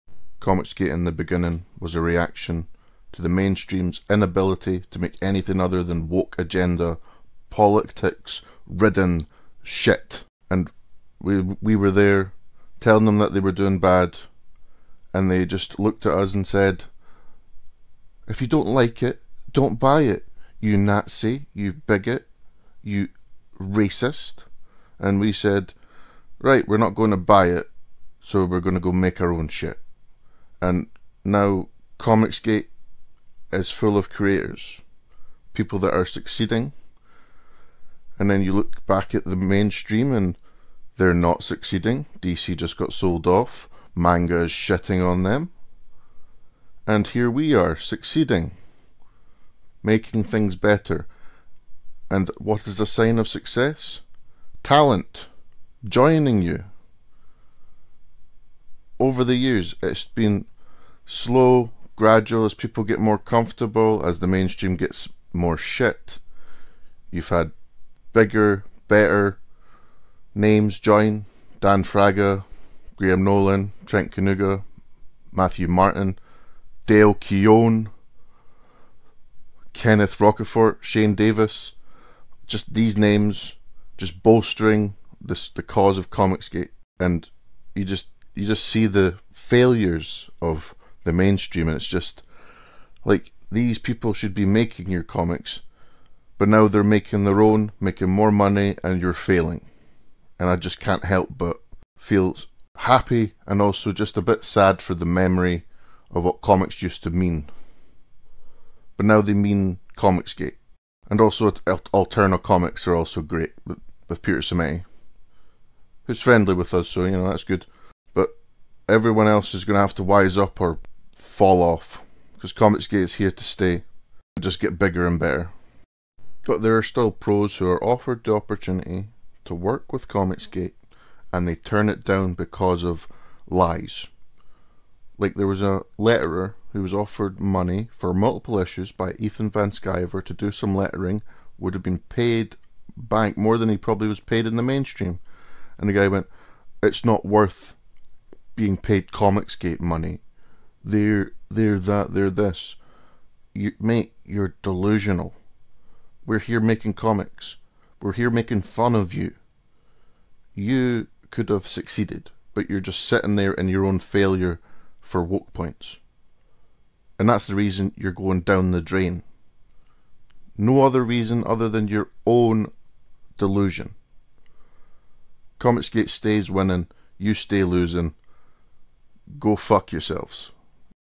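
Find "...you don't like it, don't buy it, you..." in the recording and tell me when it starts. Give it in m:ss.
0:18.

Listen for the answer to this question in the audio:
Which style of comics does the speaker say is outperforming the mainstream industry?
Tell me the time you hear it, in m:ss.
0:43.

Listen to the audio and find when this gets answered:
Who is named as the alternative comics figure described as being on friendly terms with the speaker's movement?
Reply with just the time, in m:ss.
1:54.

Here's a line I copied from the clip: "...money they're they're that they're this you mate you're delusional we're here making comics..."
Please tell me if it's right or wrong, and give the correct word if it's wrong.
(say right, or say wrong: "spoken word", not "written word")
right.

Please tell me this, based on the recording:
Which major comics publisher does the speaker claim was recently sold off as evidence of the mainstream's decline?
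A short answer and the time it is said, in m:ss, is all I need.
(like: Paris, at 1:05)
DC, at 0:42.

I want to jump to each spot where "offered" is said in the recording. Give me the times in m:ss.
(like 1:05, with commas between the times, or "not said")
2:07, 2:16.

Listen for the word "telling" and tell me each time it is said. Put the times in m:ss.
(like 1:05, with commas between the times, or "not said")
0:12.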